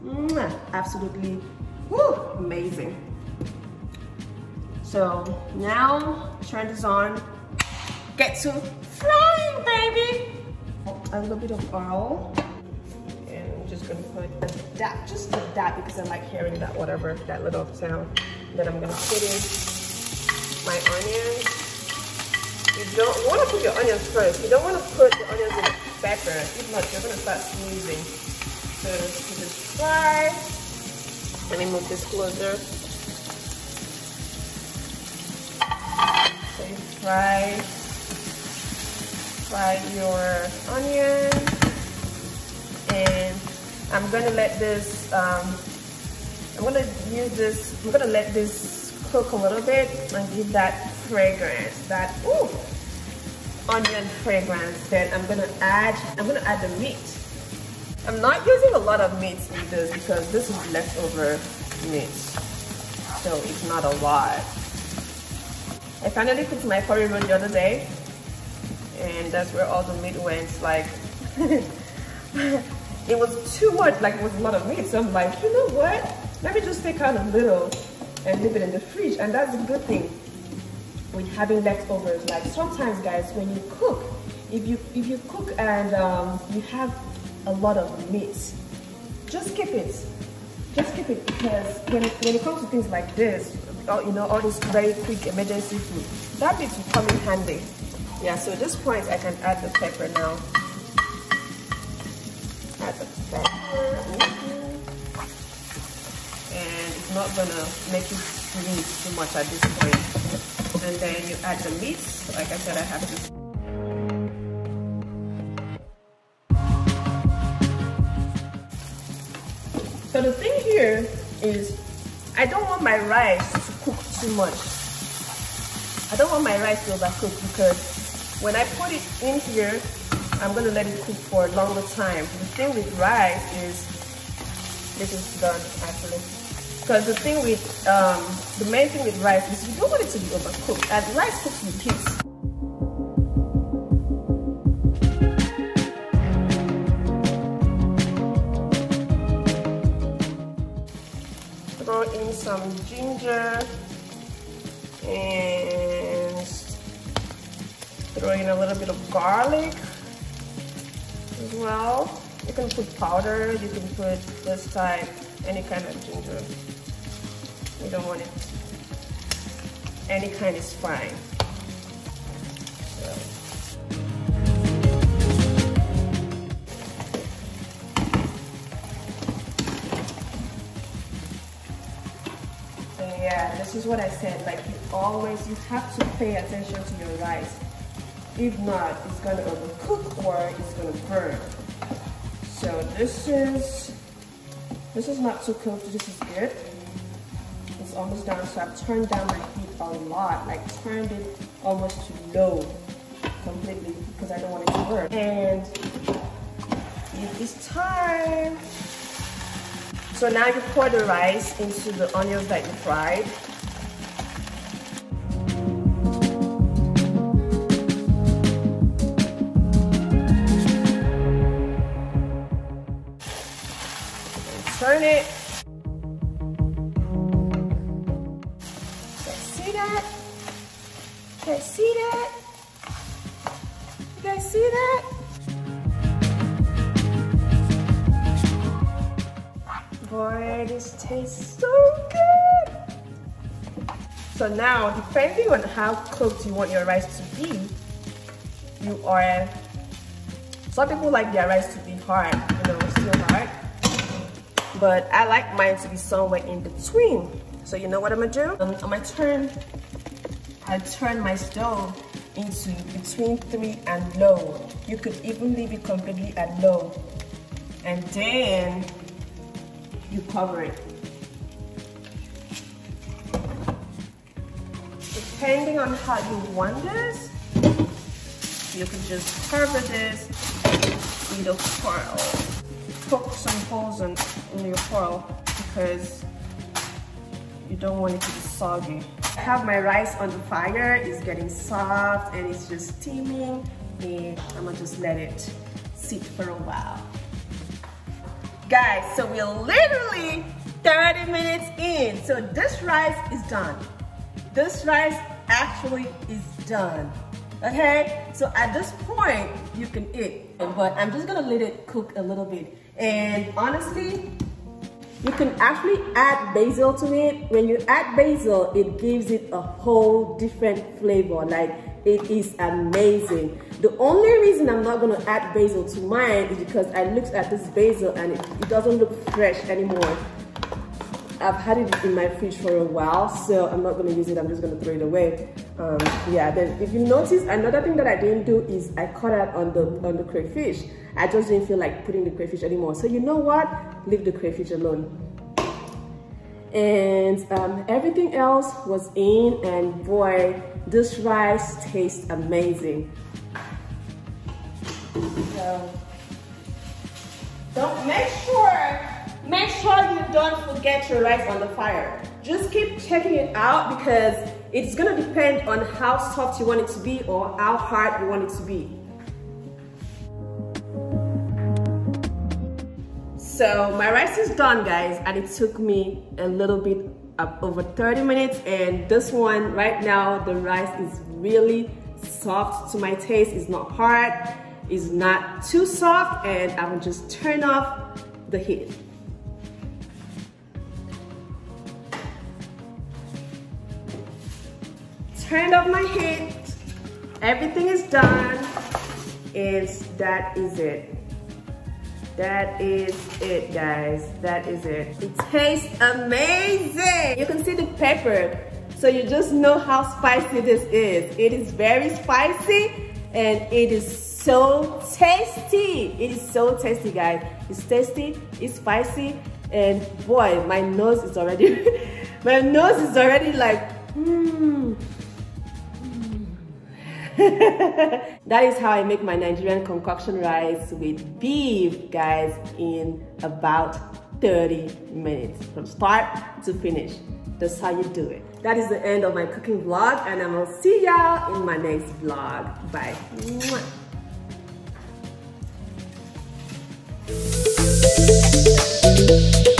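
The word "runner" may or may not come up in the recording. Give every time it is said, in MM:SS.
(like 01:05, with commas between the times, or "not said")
not said.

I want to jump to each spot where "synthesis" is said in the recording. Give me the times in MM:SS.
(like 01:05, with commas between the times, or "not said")
not said.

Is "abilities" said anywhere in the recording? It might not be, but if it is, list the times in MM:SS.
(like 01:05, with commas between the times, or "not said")
not said.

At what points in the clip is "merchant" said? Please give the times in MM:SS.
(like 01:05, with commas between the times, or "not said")
not said.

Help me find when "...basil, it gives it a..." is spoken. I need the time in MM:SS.
05:18.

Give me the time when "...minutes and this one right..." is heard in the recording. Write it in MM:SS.
06:18.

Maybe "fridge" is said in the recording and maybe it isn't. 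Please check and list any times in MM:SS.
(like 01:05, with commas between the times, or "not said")
01:18, 05:32.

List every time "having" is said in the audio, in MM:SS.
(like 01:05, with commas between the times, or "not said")
01:21.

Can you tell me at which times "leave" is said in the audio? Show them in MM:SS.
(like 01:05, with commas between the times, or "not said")
01:18, 04:25, 05:44.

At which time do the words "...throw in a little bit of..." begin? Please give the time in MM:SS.
02:38.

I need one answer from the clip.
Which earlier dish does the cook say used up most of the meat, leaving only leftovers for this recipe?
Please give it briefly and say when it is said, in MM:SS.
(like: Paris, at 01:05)
curry roll, at 01:06.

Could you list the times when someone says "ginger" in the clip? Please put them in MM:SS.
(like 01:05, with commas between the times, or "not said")
02:33, 02:46.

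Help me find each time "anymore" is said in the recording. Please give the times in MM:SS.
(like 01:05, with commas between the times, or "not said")
05:29, 05:42.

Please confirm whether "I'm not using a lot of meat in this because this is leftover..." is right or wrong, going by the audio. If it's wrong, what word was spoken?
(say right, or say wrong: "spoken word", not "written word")
right.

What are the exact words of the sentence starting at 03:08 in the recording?
If not, it's gonna overcook or it's gonna burn.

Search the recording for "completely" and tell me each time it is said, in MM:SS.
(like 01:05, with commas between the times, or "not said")
03:23, 04:25.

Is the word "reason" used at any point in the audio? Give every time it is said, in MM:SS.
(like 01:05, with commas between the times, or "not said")
05:24.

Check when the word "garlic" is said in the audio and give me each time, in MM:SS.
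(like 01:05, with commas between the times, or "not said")
02:39.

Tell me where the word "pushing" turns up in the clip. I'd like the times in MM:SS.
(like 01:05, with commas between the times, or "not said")
not said.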